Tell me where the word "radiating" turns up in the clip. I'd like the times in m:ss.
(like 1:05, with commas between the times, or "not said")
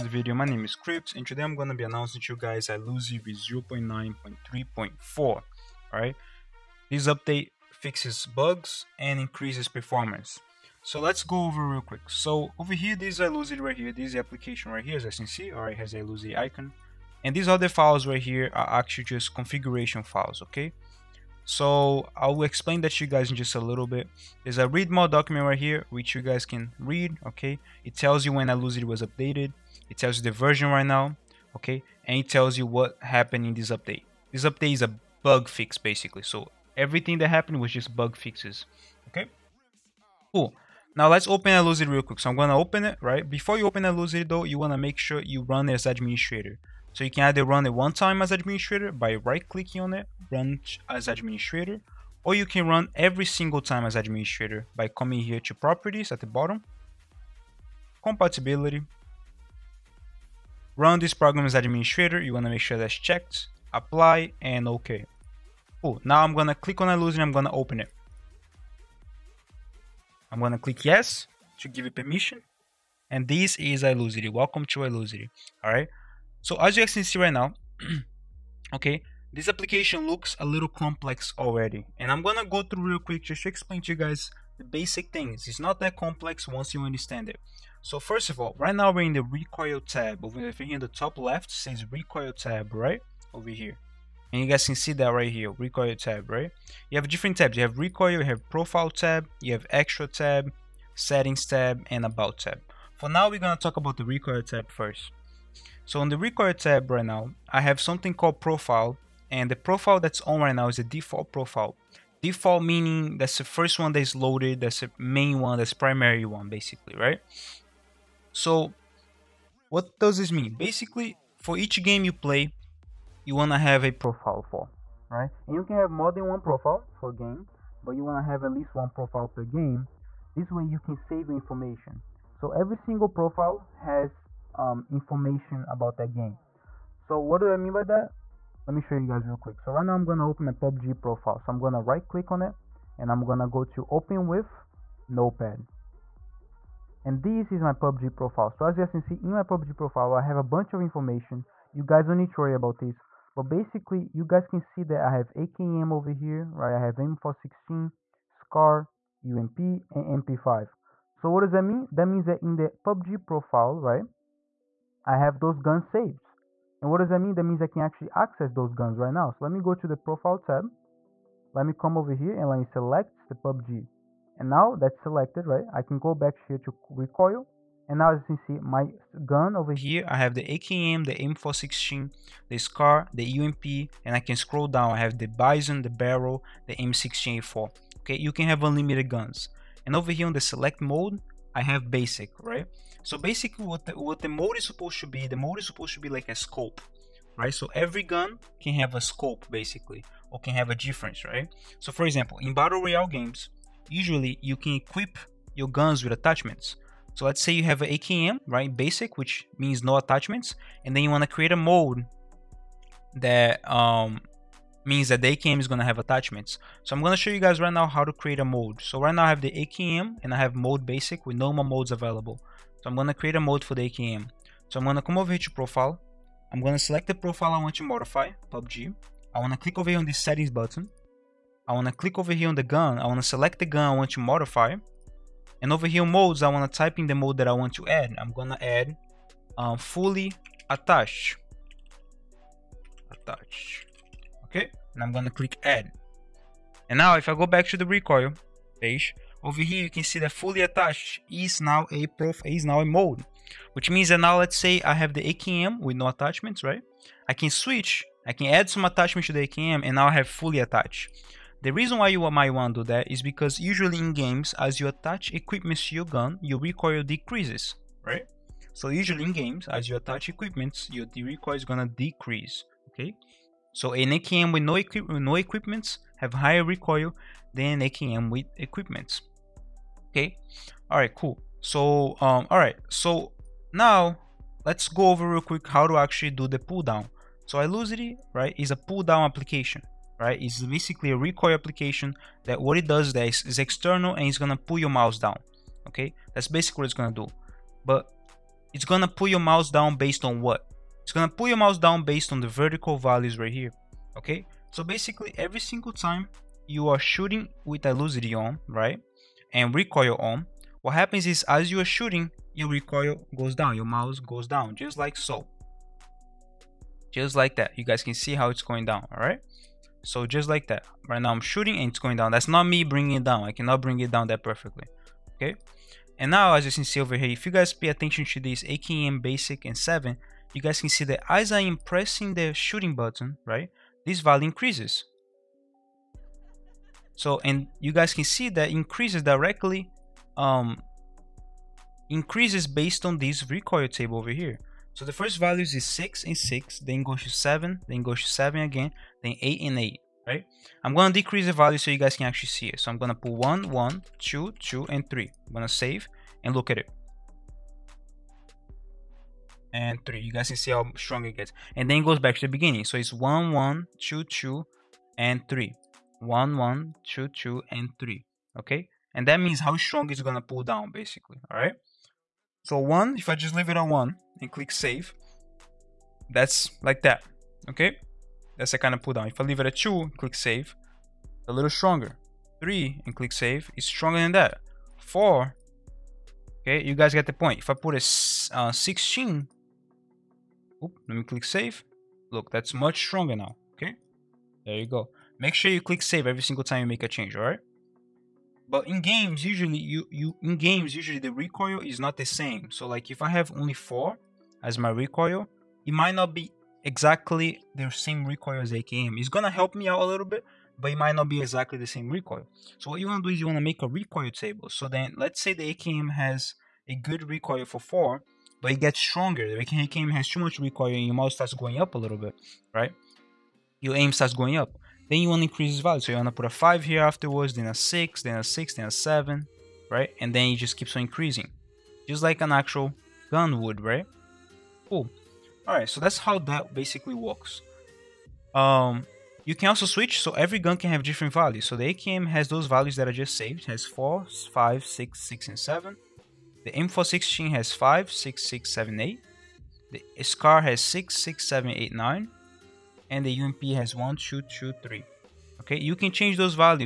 not said.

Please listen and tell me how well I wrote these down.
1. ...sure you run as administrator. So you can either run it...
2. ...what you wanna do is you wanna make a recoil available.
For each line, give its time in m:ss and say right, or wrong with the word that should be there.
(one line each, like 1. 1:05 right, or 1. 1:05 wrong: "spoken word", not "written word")
1. 0:44 right
2. 6:52 wrong: "table", not "available".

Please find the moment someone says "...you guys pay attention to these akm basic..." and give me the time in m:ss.
5:27.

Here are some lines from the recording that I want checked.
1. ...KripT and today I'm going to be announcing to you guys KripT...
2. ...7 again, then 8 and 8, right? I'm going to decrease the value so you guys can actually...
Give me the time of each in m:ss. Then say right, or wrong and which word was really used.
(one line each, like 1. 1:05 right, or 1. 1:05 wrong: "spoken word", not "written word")
1. 0:00 wrong: "Ilusity", not "KripT"
2. 5:48 right.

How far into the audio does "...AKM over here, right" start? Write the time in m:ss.
2:35.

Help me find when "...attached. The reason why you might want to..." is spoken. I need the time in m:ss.
4:20.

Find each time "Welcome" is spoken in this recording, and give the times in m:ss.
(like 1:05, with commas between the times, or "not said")
1:14.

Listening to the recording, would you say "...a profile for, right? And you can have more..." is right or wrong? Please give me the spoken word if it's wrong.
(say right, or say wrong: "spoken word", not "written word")
right.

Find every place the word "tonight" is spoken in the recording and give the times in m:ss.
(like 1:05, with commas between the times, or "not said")
not said.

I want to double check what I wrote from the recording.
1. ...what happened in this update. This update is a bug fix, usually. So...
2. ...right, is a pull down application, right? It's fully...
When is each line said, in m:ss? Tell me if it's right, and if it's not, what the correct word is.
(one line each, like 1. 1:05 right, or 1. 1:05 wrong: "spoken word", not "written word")
1. 0:32 wrong: "basically", not "usually"
2. 4:48 wrong: "basically", not "fully".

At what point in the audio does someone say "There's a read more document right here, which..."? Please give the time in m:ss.
0:24.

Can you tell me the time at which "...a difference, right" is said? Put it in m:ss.
3:20.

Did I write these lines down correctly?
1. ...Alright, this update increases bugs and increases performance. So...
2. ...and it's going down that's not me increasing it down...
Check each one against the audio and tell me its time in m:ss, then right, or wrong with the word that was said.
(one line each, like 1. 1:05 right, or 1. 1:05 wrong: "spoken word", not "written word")
1. 0:05 wrong: "fixes", not "increases"
2. 5:21 wrong: "bringing", not "increasing".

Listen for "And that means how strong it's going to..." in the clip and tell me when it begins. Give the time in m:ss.
6:09.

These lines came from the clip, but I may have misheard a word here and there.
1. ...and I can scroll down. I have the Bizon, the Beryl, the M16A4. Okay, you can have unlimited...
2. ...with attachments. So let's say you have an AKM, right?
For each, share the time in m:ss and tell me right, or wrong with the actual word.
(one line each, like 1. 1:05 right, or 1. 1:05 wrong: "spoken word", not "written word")
1. 3:04 right
2. 3:26 right.